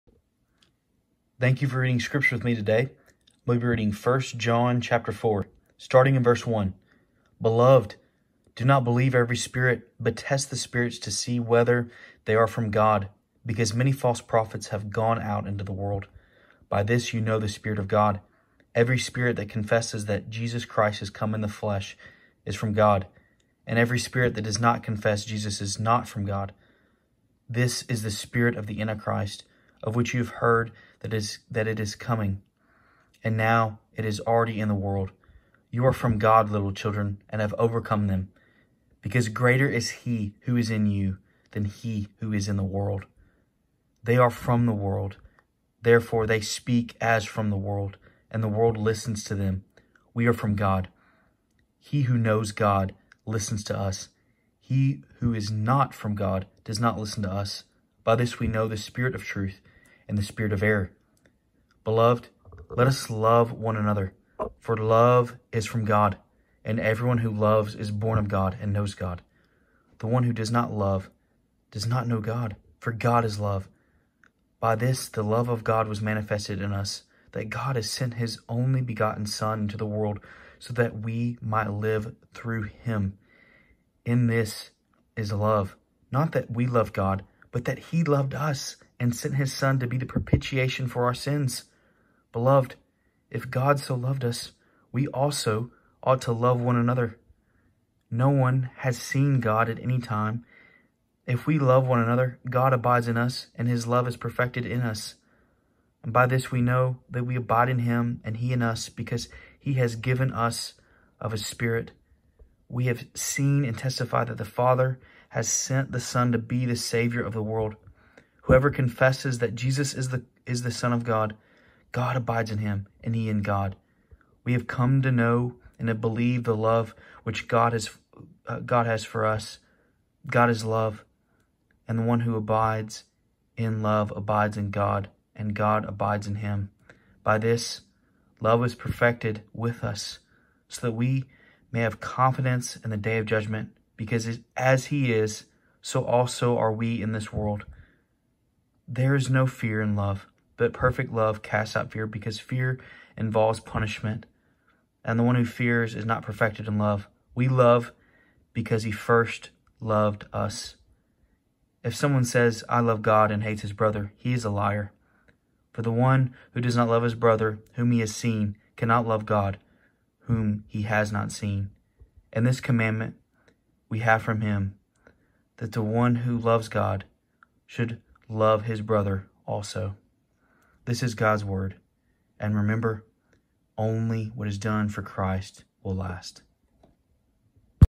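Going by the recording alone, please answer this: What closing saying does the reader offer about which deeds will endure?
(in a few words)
Only what is done for Christ will last.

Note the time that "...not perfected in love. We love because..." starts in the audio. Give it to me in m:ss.
2:36.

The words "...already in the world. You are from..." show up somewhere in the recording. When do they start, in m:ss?
0:34.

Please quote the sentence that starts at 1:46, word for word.
And by this we know that we abide in him, and he in us, because he has given us of his Spirit.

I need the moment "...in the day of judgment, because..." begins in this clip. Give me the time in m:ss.
2:22.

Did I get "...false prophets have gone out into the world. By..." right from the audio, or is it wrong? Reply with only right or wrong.
right.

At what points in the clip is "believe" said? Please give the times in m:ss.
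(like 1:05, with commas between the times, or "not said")
0:08, 2:05.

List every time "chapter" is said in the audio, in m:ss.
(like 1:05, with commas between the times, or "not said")
0:04.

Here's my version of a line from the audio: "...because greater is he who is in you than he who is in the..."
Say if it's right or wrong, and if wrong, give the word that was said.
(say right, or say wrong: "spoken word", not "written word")
right.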